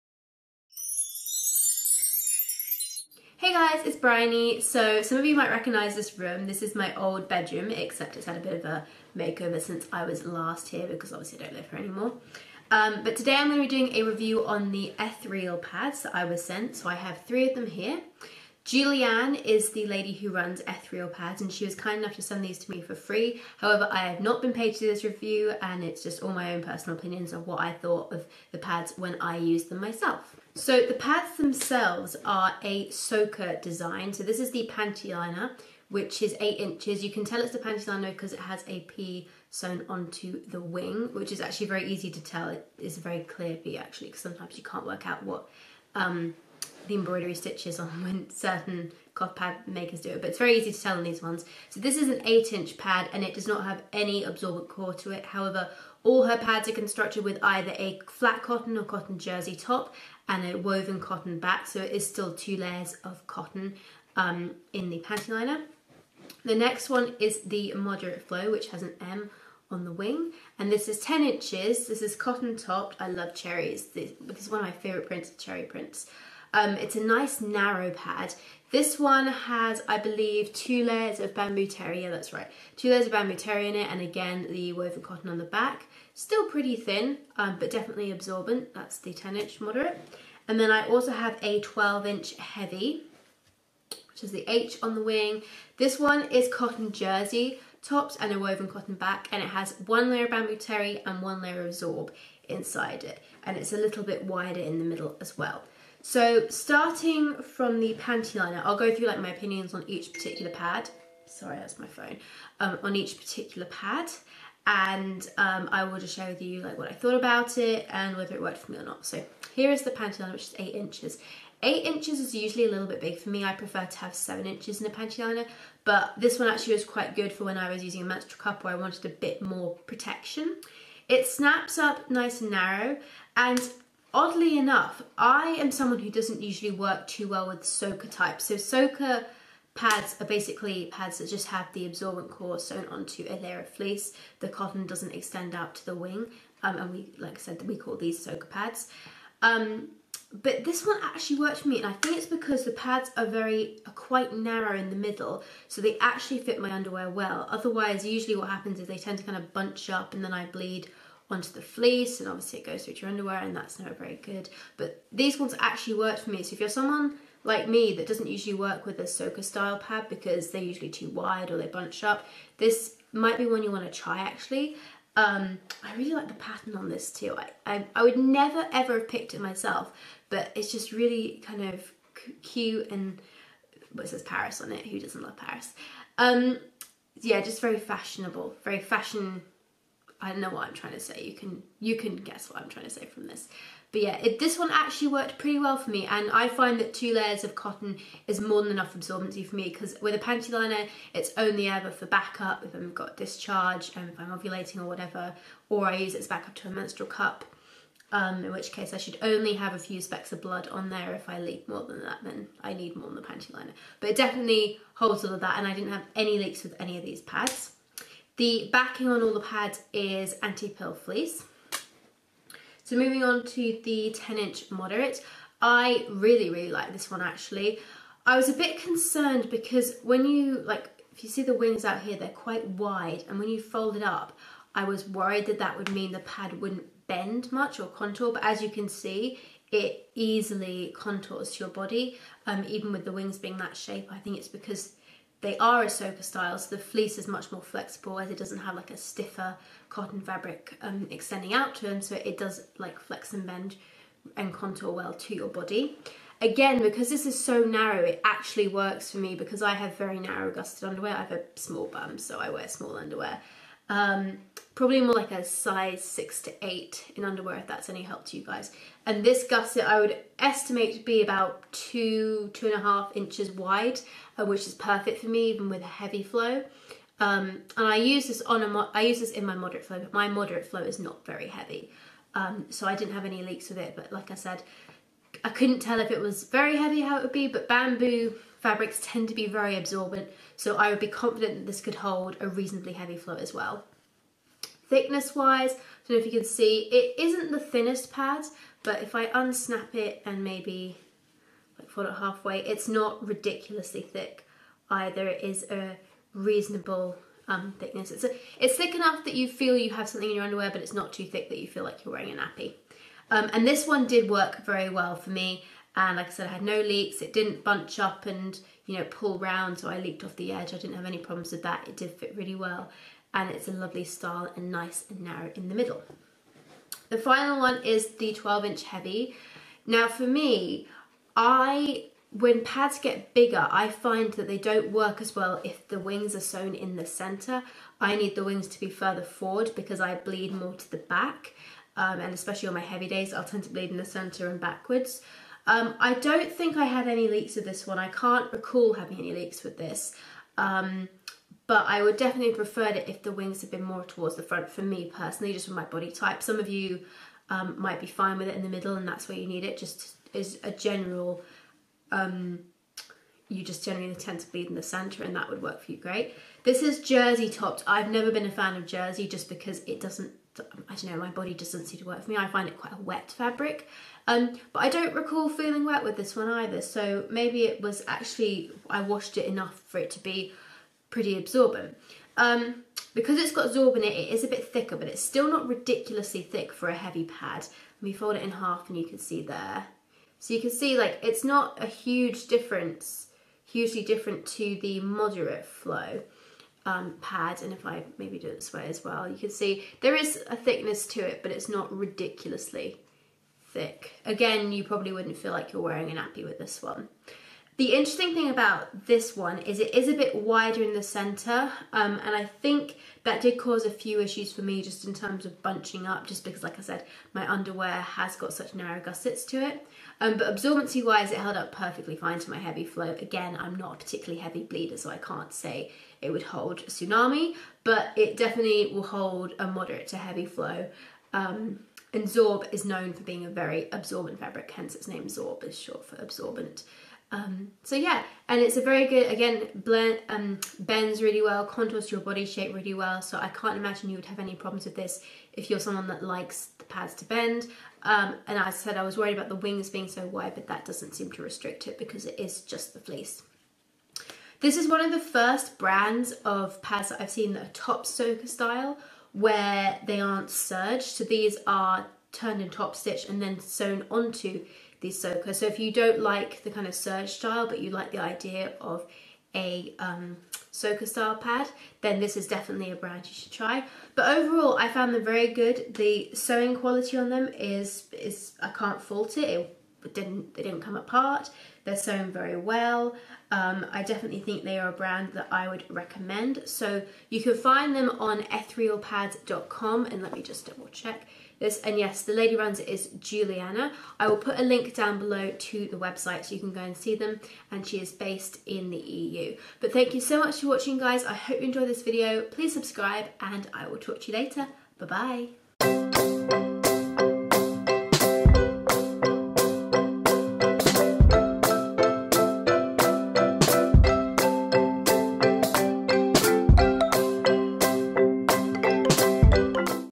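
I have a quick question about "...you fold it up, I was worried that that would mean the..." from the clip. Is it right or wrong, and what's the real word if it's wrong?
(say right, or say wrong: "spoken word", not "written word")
right.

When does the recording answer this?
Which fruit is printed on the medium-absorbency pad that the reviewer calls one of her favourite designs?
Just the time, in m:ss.
1:13.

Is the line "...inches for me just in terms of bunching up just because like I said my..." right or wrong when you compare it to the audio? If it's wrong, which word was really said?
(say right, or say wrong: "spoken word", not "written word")
wrong: "issues", not "inches".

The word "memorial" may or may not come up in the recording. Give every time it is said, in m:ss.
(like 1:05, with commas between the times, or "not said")
not said.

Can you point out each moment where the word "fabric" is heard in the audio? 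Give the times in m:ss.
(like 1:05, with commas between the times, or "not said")
4:10, 4:48, 6:13, 7:14.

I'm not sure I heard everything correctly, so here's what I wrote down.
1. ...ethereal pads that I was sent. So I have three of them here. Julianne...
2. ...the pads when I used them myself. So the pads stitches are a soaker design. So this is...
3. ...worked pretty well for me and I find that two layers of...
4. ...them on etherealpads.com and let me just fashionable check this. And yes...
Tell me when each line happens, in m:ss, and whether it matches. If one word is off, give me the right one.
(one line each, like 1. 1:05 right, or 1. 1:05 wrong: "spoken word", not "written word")
1. 0:14 right
2. 0:28 wrong: "themselves", not "stitches"
3. 3:15 right
4. 8:07 wrong: "double", not "fashionable".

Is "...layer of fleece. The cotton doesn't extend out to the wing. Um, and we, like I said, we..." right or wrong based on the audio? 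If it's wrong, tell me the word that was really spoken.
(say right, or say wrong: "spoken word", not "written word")
right.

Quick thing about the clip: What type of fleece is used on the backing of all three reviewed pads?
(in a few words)
Anti-pill fleece.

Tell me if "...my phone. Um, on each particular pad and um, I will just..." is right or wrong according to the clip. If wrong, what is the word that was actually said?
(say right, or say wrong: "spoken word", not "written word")
right.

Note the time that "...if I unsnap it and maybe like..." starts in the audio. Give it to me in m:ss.
4:59.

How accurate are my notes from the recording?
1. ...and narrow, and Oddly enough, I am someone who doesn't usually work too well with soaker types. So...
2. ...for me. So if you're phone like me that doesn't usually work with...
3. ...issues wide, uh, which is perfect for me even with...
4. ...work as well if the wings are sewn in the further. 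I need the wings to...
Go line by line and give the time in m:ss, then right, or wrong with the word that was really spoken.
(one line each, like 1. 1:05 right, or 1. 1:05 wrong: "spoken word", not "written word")
1. 2:12 right
2. 2:46 wrong: "someone", not "phone"
3. 4:33 wrong: "inches", not "issues"
4. 5:34 wrong: "center", not "further".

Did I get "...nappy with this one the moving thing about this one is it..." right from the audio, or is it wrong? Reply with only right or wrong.
wrong.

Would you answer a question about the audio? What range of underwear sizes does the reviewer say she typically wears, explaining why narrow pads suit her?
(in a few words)
Size 6 to 8.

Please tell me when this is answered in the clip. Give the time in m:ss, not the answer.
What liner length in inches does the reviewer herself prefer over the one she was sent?
2:04.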